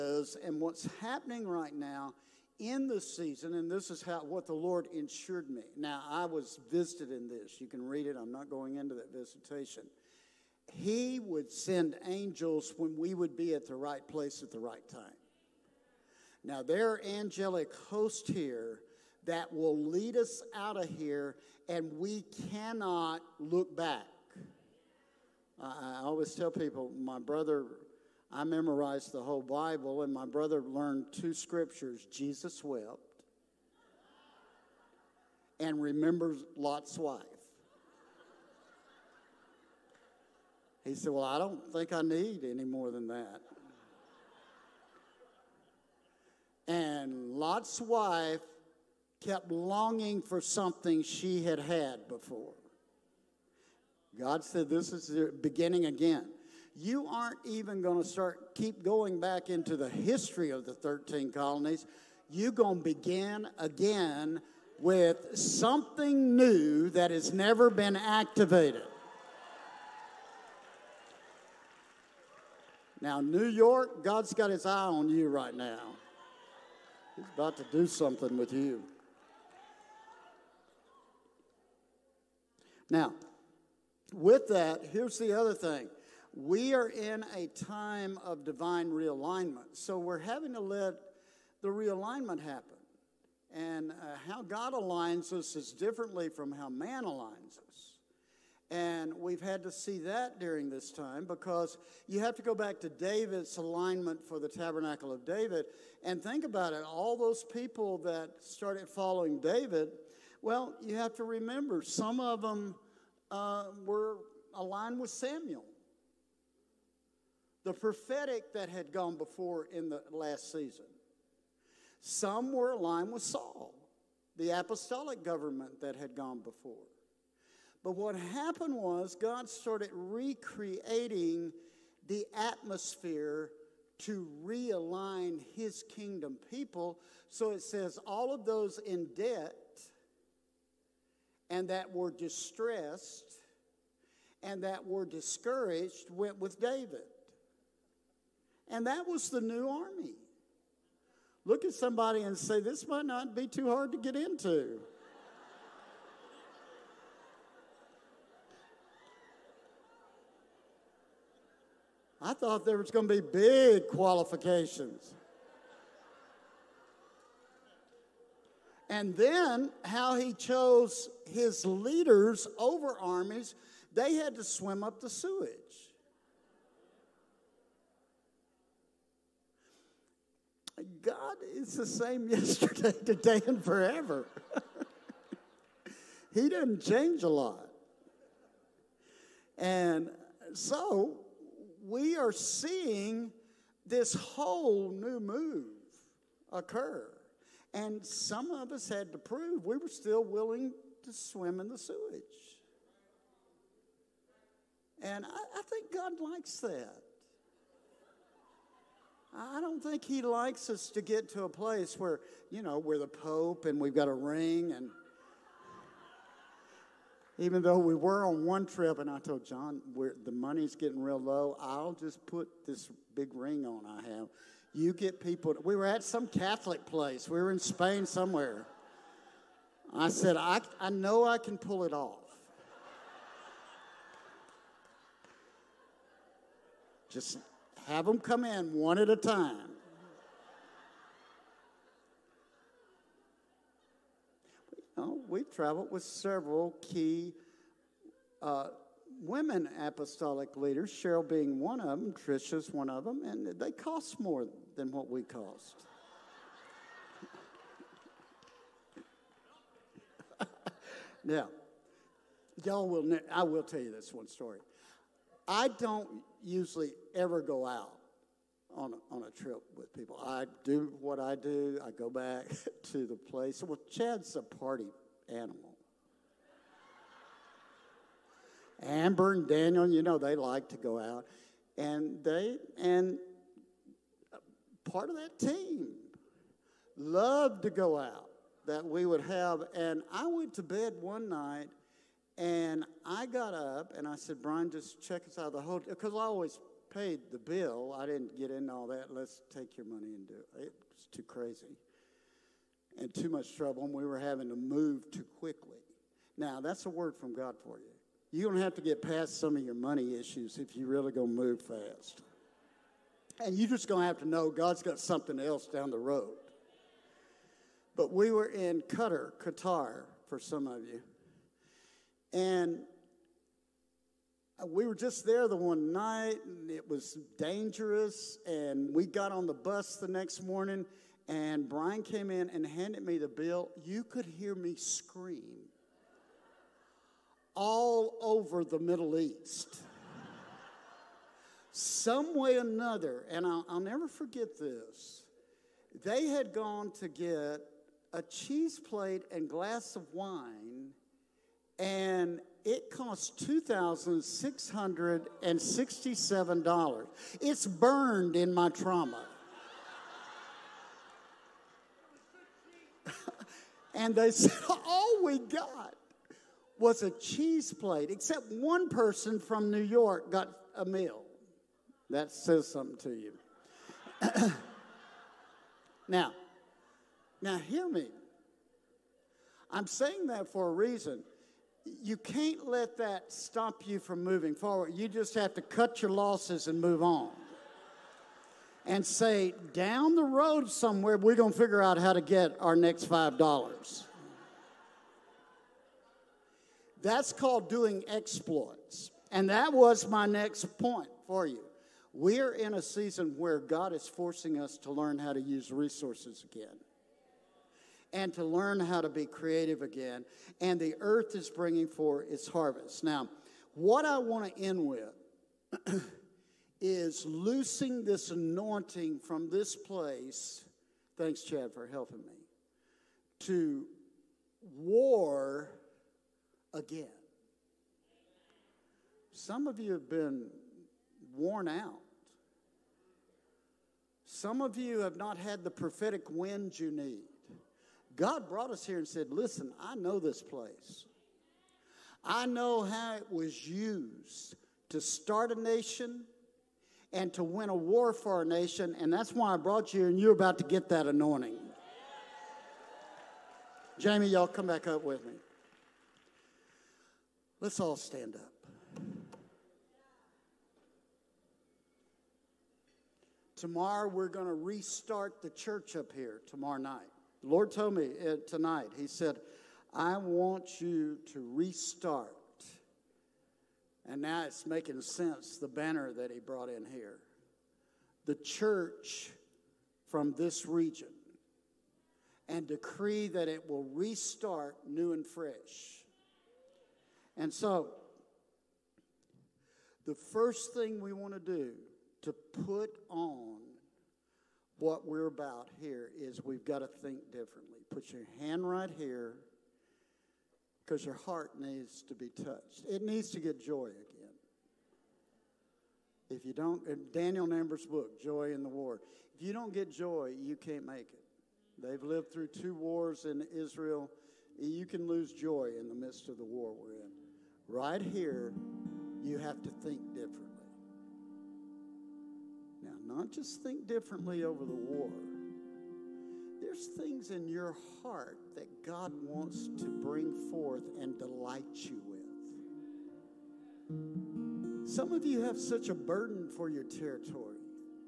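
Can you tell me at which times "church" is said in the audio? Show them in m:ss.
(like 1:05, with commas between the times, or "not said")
7:45, 7:58.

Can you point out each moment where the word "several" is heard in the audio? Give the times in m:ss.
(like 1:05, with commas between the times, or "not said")
4:06.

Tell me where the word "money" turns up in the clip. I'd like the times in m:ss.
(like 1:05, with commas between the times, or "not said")
3:40, 4:59, 5:09.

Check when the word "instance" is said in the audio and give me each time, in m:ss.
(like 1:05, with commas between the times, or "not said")
not said.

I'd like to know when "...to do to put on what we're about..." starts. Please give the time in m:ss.
8:11.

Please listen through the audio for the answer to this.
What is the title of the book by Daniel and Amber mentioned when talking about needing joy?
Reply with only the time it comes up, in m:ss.
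8:28.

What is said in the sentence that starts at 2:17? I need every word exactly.
So it says, all of those in debt and that were distressed and that were discouraged went with David.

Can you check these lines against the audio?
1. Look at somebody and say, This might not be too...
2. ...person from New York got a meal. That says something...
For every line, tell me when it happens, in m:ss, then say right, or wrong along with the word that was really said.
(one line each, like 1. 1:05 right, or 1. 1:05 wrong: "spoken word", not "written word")
1. 2:31 right
2. 6:08 right.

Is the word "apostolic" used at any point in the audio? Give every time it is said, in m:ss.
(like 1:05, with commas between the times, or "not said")
2:04, 4:09.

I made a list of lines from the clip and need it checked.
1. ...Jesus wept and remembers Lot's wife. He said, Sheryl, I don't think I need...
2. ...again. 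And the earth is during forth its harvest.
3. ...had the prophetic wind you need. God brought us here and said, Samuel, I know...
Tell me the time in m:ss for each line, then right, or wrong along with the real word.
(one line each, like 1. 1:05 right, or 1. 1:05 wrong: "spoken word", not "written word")
1. 0:32 wrong: "Well", not "Sheryl"
2. 6:49 wrong: "bringing", not "during"
3. 7:15 wrong: "Listen", not "Samuel".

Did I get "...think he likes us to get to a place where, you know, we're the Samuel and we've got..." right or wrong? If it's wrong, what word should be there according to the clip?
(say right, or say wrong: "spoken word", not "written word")
wrong: "Pope", not "Samuel".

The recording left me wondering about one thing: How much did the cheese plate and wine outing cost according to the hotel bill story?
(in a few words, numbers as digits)
$2,667.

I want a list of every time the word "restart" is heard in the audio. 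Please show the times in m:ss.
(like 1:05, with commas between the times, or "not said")
7:44, 7:51, 8:03.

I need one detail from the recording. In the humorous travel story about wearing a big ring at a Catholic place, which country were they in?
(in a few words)
Spain.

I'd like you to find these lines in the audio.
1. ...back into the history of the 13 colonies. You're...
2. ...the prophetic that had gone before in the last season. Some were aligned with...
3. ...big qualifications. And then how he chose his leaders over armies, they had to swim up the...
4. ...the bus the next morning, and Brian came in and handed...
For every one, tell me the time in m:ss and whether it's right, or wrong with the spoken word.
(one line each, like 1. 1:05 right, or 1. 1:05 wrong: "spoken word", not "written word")
1. 0:59 right
2. 1:57 right
3. 2:43 right
4. 5:29 right.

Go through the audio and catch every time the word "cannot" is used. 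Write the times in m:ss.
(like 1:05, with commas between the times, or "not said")
0:22.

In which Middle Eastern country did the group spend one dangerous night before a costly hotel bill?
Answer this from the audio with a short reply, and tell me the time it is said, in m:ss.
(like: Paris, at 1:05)
Qatar, at 5:18.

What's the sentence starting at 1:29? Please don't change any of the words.
So we're having to let the realignment happen.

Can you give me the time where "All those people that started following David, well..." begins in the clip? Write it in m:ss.
1:46.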